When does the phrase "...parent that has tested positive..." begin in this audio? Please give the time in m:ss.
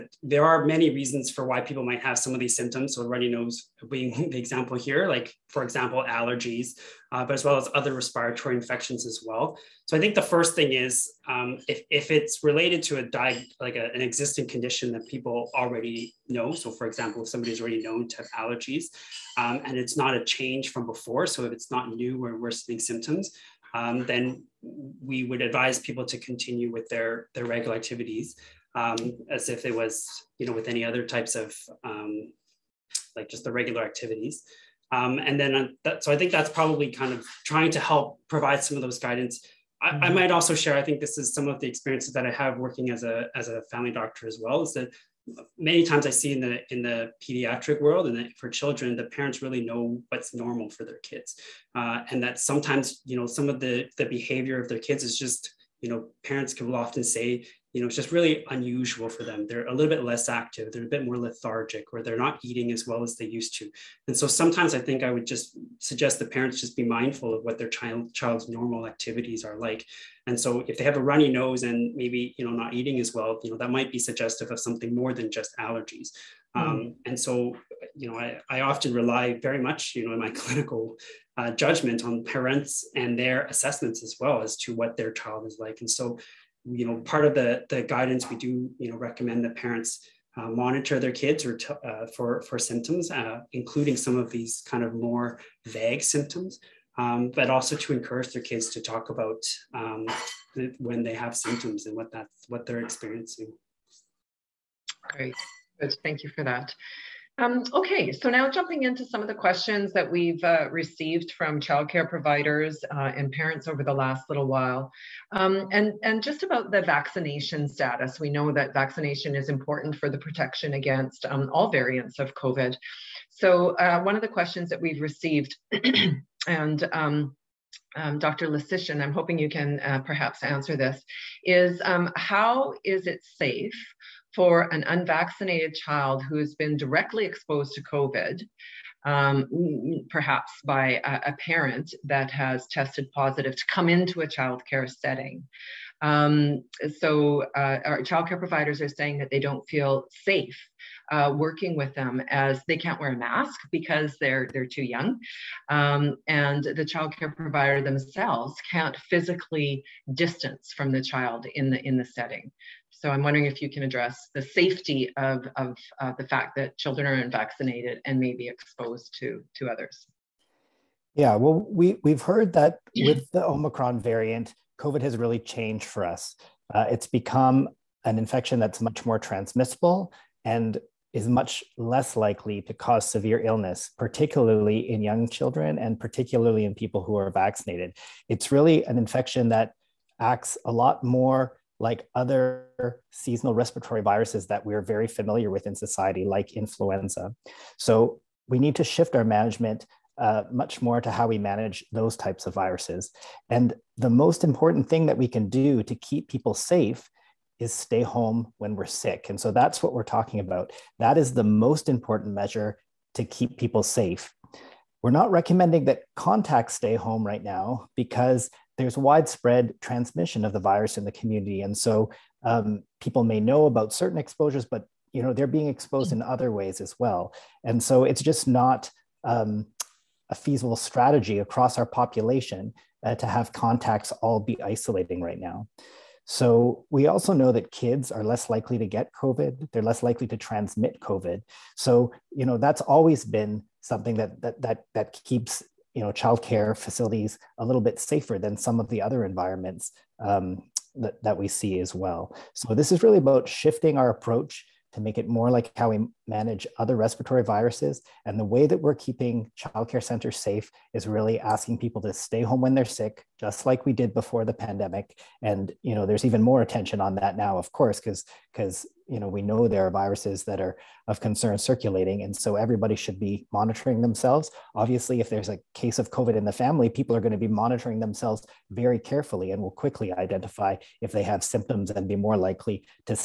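2:21.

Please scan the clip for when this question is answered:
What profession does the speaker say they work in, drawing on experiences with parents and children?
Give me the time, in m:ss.
0:43.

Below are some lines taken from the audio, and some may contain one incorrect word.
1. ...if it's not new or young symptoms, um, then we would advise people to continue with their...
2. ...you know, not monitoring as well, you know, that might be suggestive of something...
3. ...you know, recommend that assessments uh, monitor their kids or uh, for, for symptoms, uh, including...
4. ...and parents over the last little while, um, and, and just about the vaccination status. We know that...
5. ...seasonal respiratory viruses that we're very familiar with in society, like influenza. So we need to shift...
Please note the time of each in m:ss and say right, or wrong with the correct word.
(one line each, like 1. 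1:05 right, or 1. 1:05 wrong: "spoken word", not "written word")
1. 0:21 wrong: "worsening", not "young"
2. 1:12 wrong: "eating", not "monitoring"
3. 1:28 wrong: "parents", not "assessments"
4. 1:53 right
5. 3:13 right.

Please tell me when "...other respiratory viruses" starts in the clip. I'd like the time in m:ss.
4:16.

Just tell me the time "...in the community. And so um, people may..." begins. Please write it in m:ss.
3:40.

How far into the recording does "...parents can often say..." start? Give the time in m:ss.
0:56.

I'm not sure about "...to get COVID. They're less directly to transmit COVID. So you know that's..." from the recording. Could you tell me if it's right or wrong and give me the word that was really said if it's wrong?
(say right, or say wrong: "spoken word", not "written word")
wrong: "likely", not "directly".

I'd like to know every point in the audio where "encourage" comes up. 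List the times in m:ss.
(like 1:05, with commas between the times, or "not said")
1:37.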